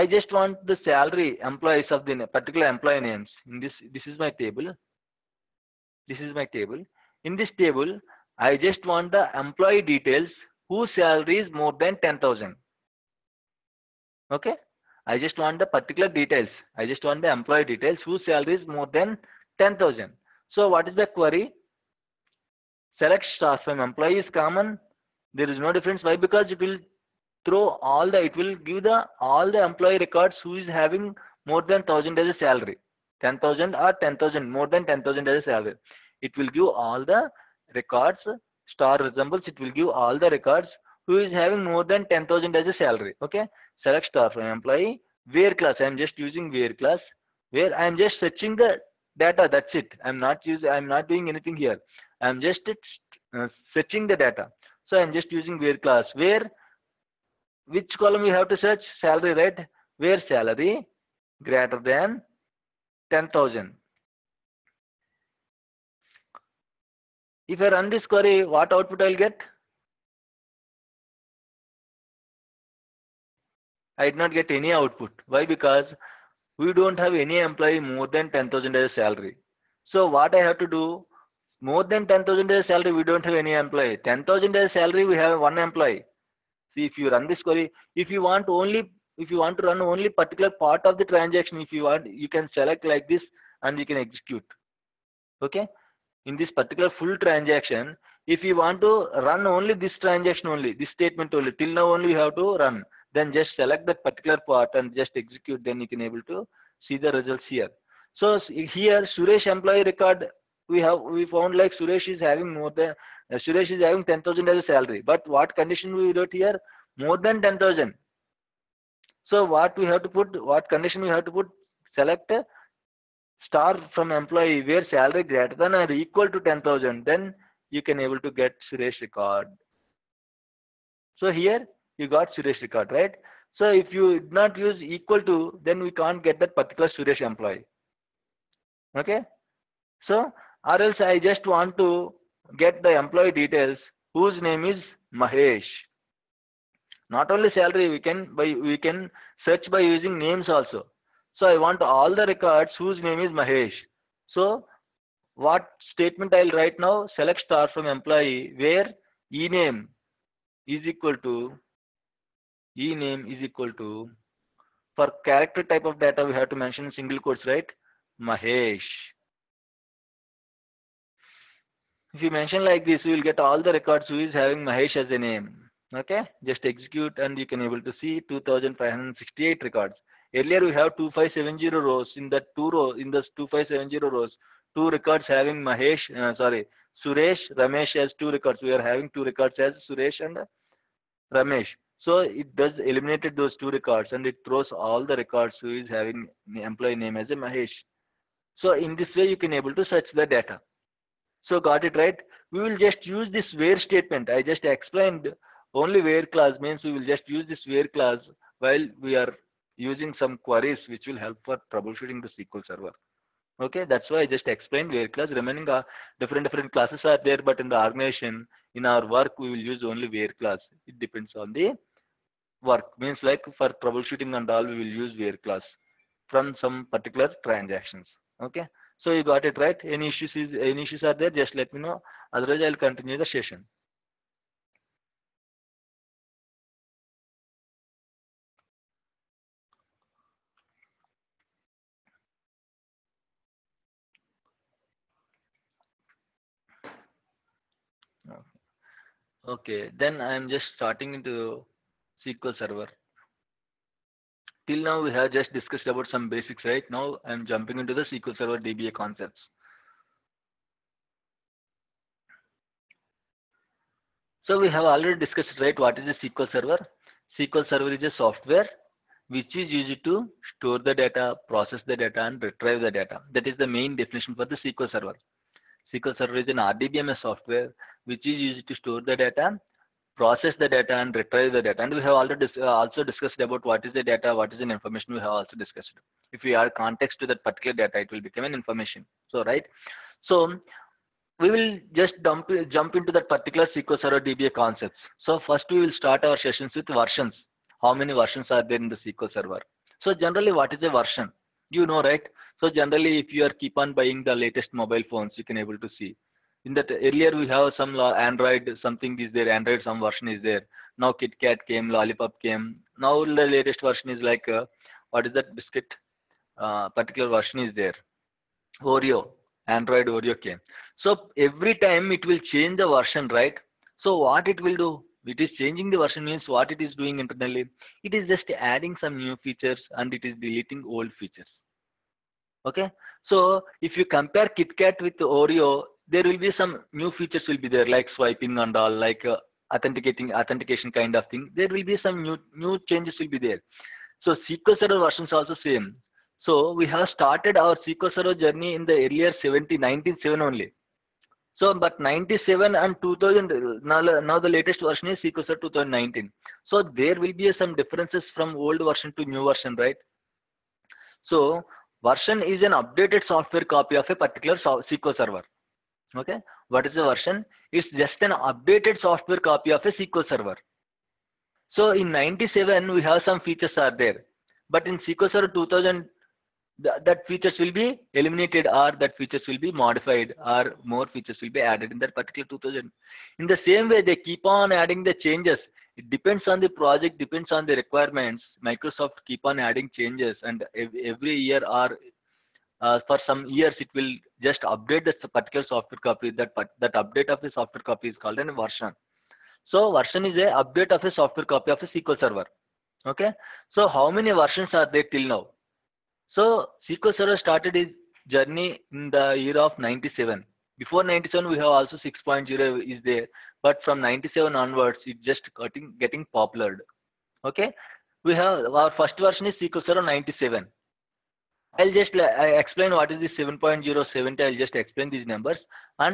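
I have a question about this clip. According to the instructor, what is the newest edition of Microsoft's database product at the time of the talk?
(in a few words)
SQL Server 2019.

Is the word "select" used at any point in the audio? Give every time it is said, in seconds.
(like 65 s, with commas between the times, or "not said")
22 s, 43 s, 92 s, 103 s, 121 s, 157 s.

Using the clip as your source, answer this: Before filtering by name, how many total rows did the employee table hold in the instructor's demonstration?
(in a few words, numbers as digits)
2570.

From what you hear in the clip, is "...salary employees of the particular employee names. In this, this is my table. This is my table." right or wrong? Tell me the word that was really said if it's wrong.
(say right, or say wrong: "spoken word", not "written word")
right.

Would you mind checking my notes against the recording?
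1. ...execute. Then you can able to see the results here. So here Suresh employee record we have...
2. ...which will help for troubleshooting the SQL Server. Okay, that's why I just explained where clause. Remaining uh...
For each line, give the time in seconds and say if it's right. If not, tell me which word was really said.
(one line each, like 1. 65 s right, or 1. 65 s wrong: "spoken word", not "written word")
1. 105 s right
2. 210 s right.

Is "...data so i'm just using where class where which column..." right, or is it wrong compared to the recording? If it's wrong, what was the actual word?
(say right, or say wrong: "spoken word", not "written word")
right.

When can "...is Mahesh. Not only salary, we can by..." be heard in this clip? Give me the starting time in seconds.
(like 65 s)
144 s.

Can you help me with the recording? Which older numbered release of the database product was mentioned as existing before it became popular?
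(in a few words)
6.0.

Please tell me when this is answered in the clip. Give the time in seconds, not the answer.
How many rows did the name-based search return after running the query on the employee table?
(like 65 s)
178 s.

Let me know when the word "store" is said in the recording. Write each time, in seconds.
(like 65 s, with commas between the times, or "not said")
270 s, 278 s.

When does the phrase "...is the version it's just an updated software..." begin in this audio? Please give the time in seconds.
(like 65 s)
366 s.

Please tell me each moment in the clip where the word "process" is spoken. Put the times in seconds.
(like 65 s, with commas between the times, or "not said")
271 s, 280 s.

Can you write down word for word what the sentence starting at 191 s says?
So it does eliminated those two records and it throws all the records who is having employee name as a Mahesh.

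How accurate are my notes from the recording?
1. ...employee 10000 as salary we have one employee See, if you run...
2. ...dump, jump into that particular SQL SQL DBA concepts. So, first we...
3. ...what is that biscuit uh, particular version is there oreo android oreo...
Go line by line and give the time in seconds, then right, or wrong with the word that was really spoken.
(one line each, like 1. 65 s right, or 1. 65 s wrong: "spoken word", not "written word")
1. 83 s right
2. 292 s wrong: "Server", not "SQL"
3. 315 s right.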